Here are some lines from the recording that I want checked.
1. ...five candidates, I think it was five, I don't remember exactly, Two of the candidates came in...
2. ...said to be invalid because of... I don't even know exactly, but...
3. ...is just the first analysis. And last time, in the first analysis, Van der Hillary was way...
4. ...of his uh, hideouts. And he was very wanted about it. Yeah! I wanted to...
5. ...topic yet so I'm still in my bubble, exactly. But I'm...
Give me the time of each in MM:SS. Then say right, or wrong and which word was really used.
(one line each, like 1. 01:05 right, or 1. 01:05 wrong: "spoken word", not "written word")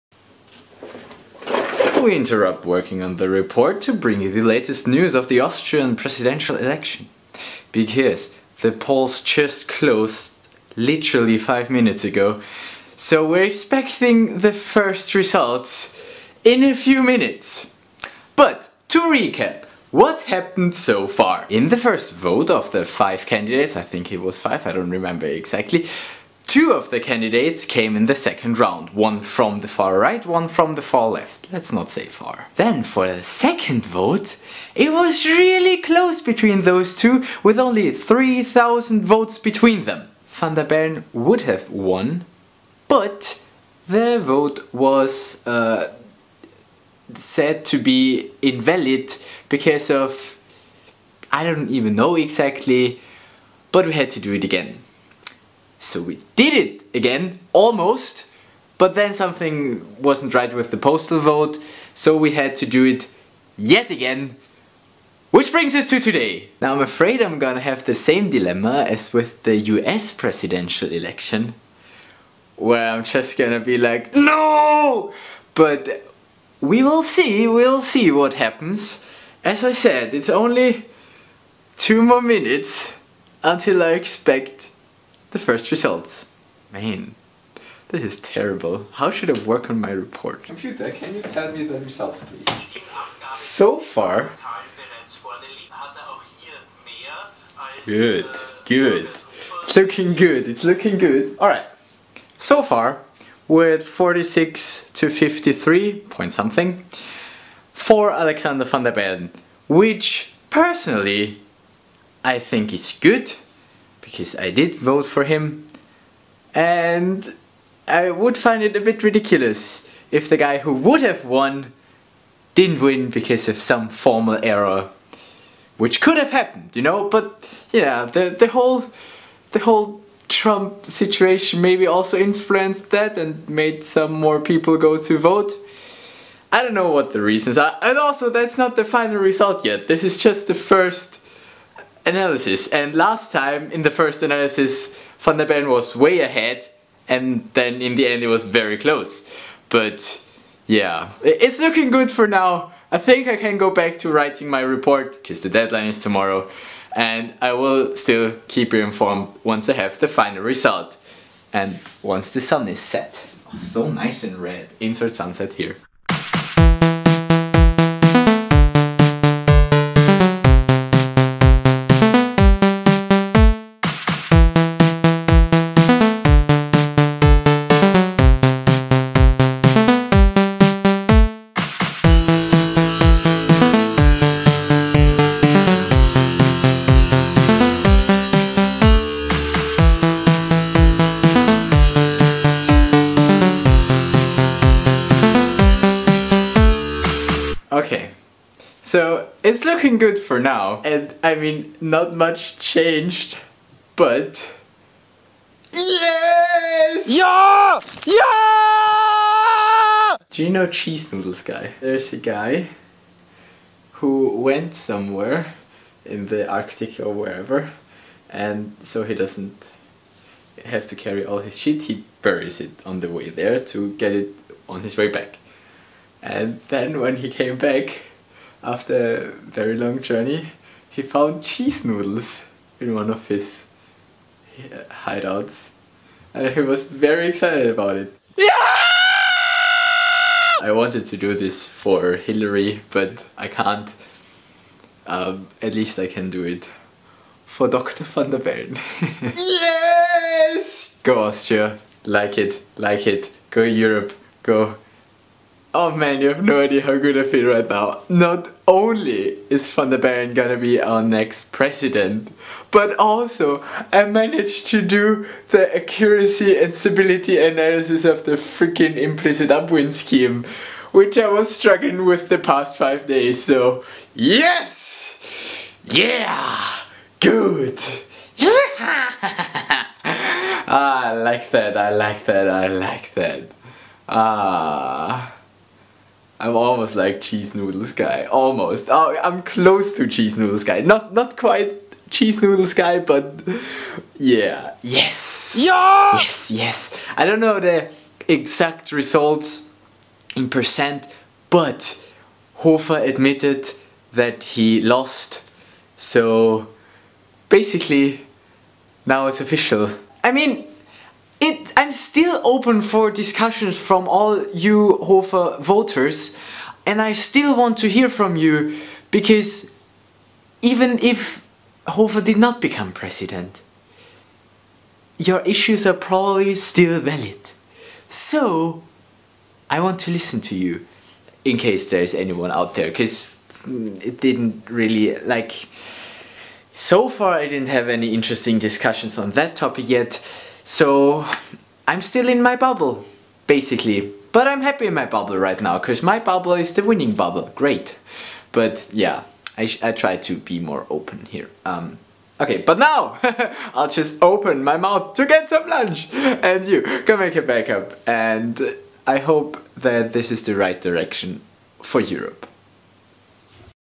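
1. 00:22 right
2. 00:47 right
3. 02:20 wrong: "Bellen", not "Hillary"
4. 03:53 wrong: "excited", not "wanted"
5. 05:39 wrong: "basically", not "exactly".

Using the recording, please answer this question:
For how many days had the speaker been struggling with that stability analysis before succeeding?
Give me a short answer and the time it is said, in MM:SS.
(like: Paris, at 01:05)
5, at 04:32.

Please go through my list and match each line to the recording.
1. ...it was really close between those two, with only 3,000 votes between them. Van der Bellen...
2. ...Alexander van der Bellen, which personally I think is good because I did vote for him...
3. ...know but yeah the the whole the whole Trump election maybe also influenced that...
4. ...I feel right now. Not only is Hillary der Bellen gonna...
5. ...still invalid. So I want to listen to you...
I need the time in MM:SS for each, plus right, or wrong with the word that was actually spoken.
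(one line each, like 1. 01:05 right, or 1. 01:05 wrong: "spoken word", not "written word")
1. 00:34 right
2. 01:48 right
3. 02:06 wrong: "situation", not "election"
4. 04:17 wrong: "Van", not "Hillary"
5. 05:26 wrong: "valid", not "invalid".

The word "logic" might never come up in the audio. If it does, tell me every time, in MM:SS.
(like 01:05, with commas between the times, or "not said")
not said.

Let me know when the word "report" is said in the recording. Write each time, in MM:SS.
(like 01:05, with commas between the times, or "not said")
00:03, 01:29, 02:34.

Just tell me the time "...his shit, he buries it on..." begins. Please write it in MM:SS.
03:41.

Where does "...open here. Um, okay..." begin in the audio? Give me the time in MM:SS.
05:50.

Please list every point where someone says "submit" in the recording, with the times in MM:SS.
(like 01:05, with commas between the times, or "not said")
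not said.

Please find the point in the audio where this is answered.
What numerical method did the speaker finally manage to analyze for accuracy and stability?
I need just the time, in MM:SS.
04:28.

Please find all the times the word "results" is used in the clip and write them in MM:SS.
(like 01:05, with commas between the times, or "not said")
00:15, 01:25, 01:31, 02:19, 02:40, 04:58.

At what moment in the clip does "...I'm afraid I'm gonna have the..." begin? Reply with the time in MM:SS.
01:06.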